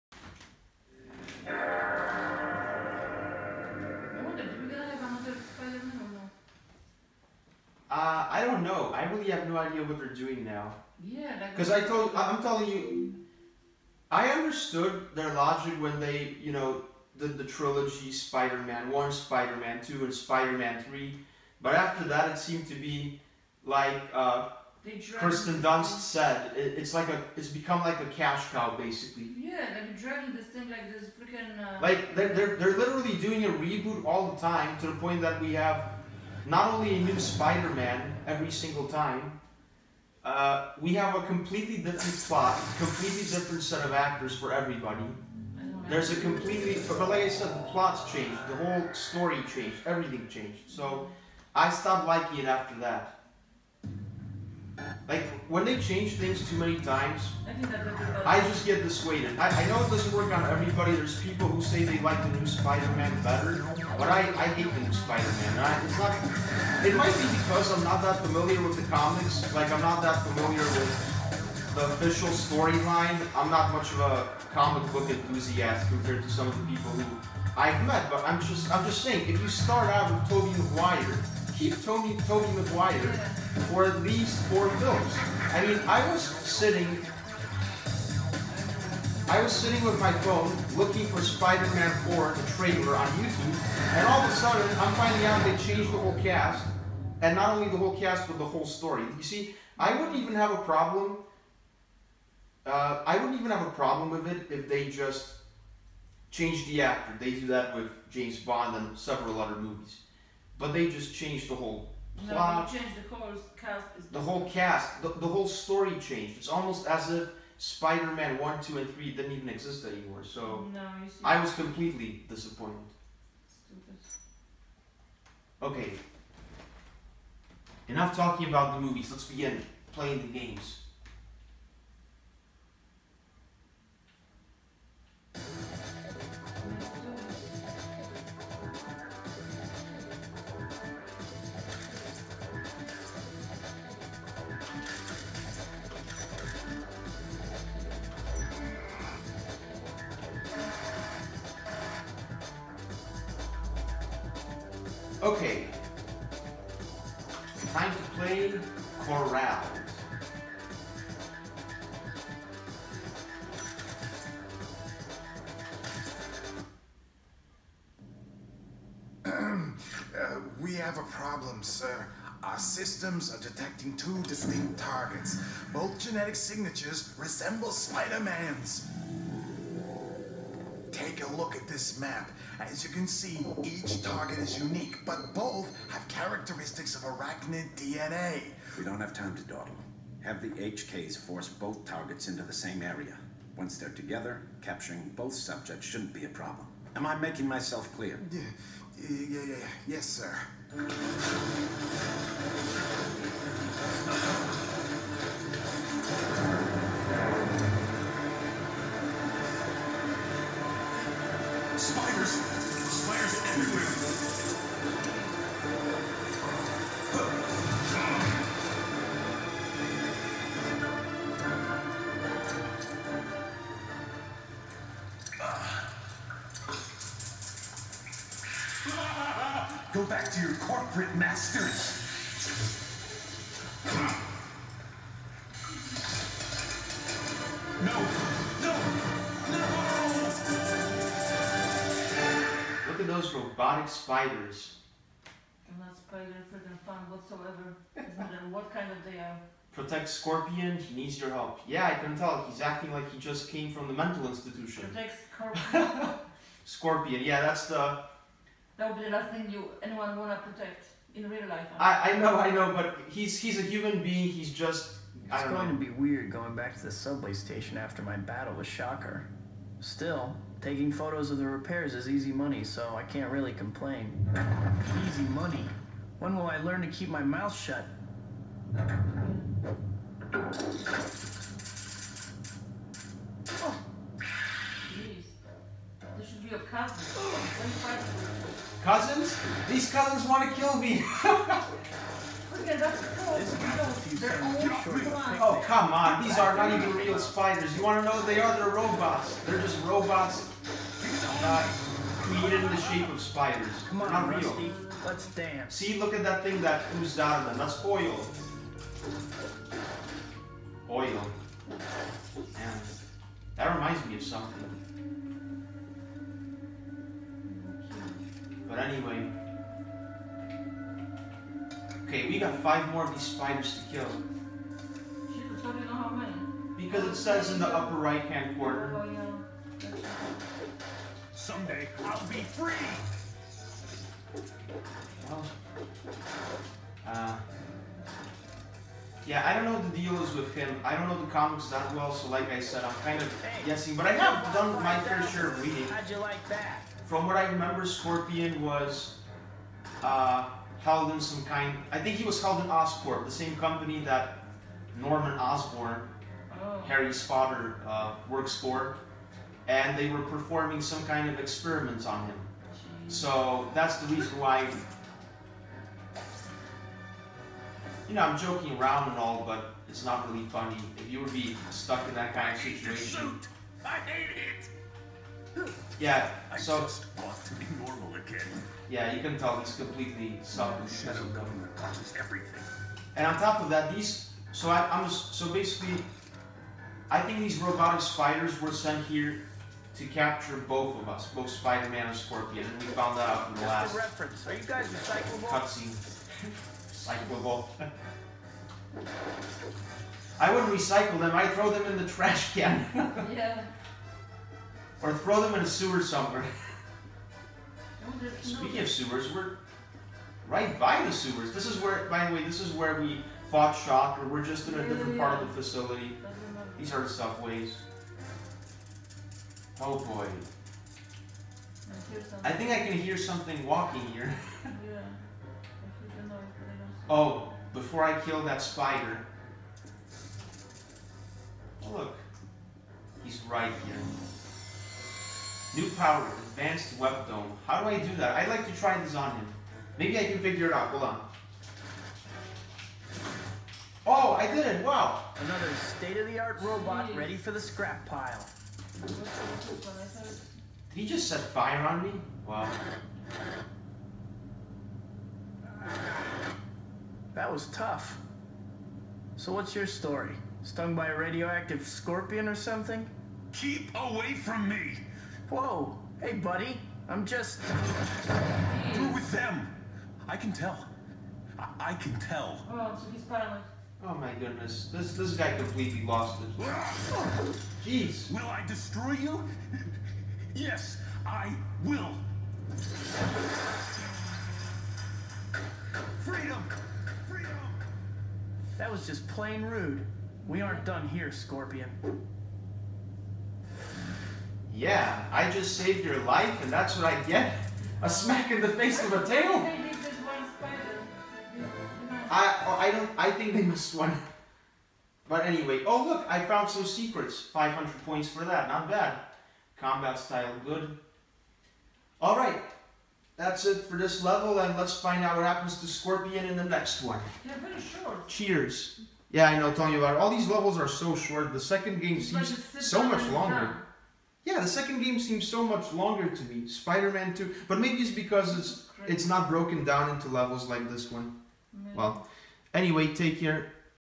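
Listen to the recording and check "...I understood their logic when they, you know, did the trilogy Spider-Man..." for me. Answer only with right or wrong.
right.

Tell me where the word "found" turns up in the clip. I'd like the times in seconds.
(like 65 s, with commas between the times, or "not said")
392 s, 506 s.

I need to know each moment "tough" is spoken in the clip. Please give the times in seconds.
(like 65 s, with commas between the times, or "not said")
457 s.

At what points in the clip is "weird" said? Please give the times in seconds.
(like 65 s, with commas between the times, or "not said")
265 s.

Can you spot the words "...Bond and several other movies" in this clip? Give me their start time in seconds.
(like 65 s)
108 s.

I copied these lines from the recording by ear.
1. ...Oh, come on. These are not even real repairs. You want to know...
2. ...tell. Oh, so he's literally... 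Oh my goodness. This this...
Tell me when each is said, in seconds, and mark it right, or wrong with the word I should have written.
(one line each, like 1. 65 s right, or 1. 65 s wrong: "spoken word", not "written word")
1. 295 s wrong: "spiders", not "repairs"
2. 472 s wrong: "finally", not "literally".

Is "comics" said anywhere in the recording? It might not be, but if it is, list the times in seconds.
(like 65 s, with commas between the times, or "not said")
68 s, 74 s, 341 s.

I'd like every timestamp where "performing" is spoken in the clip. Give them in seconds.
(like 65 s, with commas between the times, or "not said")
360 s.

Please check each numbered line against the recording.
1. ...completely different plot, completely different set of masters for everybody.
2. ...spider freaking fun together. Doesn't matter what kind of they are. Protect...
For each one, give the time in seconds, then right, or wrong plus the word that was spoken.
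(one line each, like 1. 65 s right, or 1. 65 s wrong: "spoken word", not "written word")
1. 41 s wrong: "actors", not "masters"
2. 245 s wrong: "whatsoever", not "together".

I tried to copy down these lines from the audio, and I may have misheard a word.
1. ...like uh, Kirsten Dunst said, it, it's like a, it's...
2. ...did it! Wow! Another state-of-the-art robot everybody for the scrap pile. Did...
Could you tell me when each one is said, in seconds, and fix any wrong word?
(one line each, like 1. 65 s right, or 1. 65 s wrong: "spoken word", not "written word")
1. 23 s right
2. 444 s wrong: "ready", not "everybody".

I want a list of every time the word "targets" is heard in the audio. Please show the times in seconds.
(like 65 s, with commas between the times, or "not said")
174 s, 184 s, 191 s.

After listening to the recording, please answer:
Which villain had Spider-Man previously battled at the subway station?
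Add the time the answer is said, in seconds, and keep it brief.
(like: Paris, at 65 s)
Shocker, at 268 s.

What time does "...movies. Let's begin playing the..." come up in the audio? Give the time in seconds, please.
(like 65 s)
128 s.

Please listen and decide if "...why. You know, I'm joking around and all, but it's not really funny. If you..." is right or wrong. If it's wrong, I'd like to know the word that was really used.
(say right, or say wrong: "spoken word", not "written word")
right.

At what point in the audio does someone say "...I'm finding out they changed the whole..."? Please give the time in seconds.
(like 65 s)
94 s.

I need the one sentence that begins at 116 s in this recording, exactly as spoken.
It's almost as if Spider-Man one, two, and three didn't even exist anymore.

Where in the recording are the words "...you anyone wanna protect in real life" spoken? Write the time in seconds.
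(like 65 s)
259 s.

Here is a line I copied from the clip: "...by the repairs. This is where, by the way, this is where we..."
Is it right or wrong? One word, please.
wrong.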